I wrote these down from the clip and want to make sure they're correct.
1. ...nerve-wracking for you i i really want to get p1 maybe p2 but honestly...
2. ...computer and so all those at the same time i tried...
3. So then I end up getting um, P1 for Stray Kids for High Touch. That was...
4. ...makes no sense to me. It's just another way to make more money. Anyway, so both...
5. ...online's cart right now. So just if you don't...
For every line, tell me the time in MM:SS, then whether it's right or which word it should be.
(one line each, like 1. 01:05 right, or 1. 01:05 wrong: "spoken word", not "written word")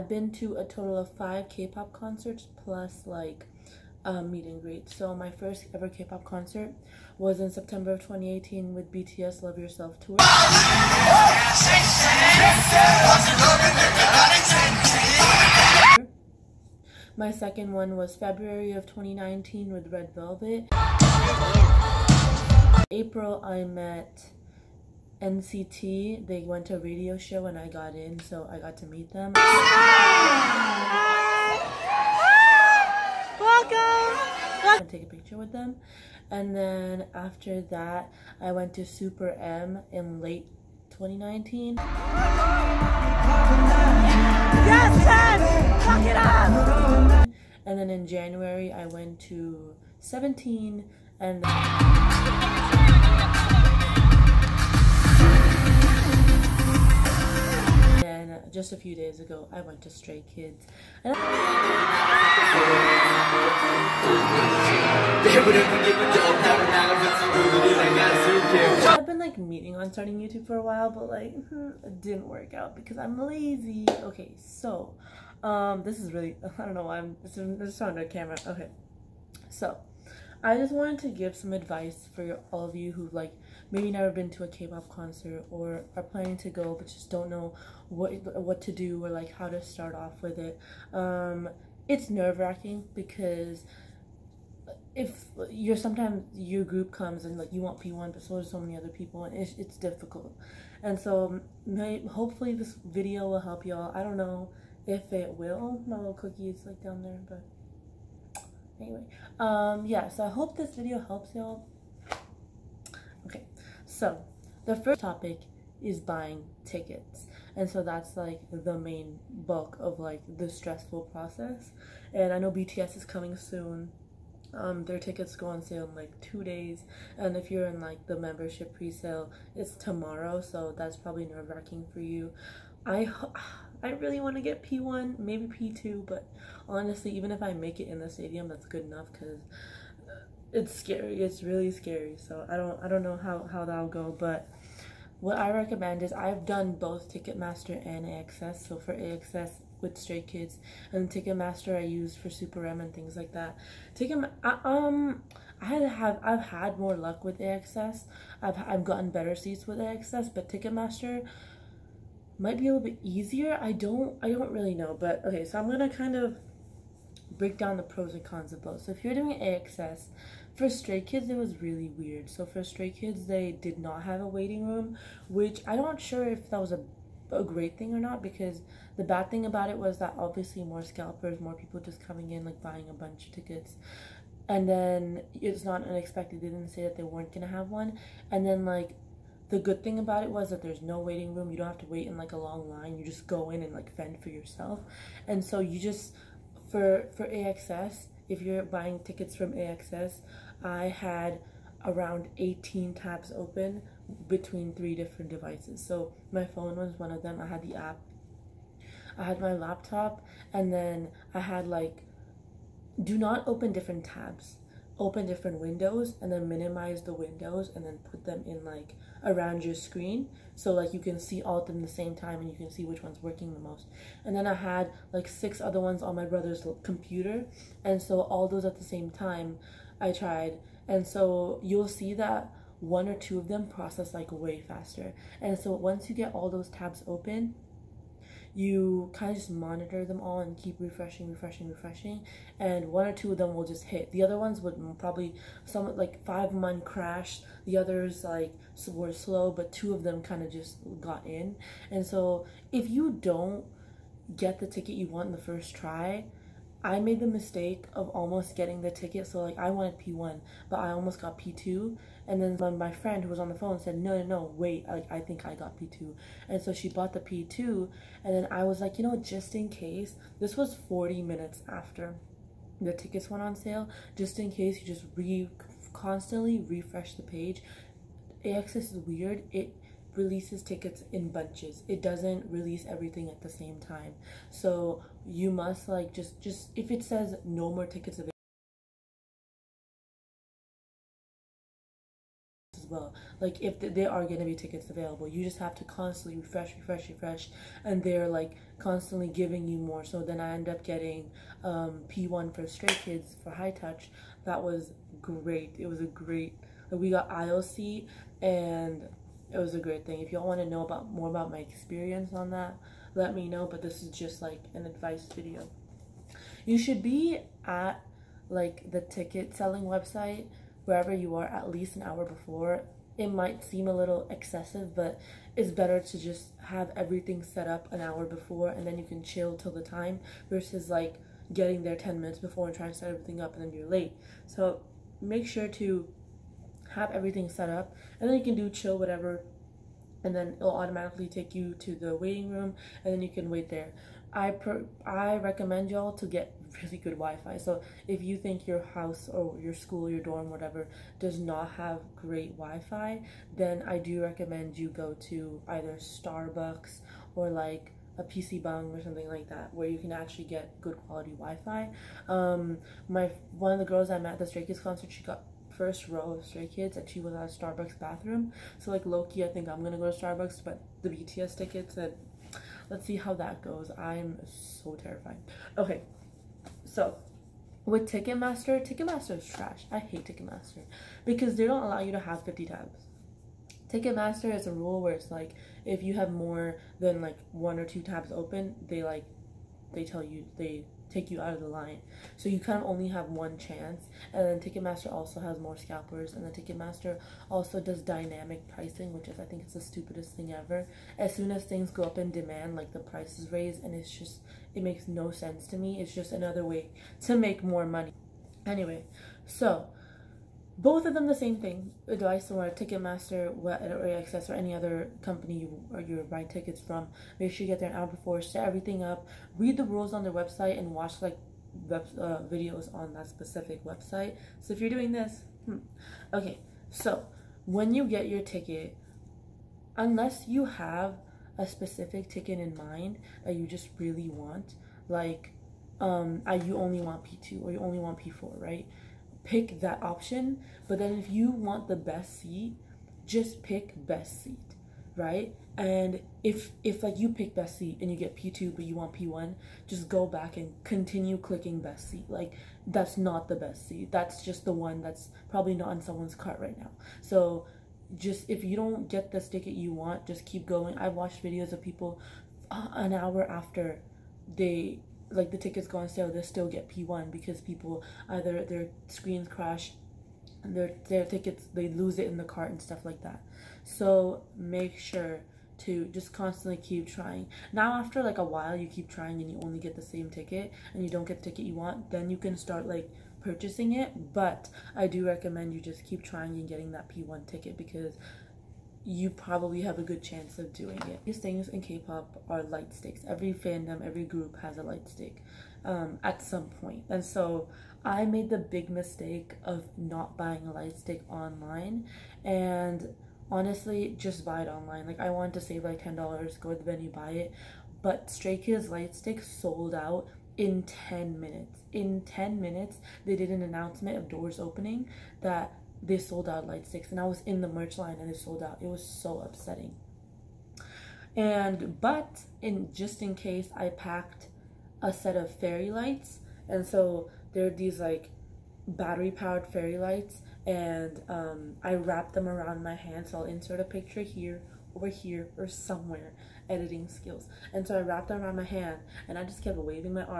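1. 02:11 right
2. 03:46 right
3. 05:00 right
4. 06:44 right
5. 07:36 wrong: "someone", not "online".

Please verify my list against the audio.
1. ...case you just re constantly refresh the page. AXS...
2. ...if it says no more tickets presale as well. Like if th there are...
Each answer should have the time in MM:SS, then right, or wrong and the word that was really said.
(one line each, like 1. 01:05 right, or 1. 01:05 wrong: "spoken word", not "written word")
1. 04:34 right
2. 04:46 wrong: "available", not "presale".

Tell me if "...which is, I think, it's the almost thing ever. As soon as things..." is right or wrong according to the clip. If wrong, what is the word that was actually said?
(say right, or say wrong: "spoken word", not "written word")
wrong: "stupidest", not "almost".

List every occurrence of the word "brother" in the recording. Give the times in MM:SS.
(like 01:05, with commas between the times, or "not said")
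03:46.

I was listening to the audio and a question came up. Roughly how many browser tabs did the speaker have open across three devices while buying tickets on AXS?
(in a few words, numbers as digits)
18.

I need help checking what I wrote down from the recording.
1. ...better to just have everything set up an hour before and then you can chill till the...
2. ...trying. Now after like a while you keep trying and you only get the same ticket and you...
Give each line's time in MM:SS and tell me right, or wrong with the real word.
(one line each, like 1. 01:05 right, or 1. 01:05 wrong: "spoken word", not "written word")
1. 05:25 right
2. 07:57 right.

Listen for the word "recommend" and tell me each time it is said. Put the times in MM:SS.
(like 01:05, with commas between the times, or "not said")
02:25, 05:45, 05:54, 08:05.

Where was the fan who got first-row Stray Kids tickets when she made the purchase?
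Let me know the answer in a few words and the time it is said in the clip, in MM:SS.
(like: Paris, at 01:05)
Starbucks bathroom, at 06:07.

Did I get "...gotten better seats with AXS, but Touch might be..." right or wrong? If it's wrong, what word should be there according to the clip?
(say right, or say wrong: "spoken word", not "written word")
wrong: "Ticketmaster", not "Touch".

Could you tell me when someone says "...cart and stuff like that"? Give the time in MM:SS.
07:52.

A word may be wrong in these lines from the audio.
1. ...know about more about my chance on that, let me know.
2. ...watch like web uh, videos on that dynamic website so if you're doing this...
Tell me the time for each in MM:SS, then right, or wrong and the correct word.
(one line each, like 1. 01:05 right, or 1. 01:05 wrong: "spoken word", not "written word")
1. 05:10 wrong: "experience", not "chance"
2. 07:00 wrong: "specific", not "dynamic".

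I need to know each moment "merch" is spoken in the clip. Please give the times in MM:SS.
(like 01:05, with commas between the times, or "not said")
08:37.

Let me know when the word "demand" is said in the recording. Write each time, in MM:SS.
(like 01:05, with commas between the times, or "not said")
06:42.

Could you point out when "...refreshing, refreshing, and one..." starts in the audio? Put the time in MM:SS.
04:01.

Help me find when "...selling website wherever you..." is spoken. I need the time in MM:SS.
05:19.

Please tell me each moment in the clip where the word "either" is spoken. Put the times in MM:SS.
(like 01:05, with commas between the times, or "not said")
05:55, 07:48.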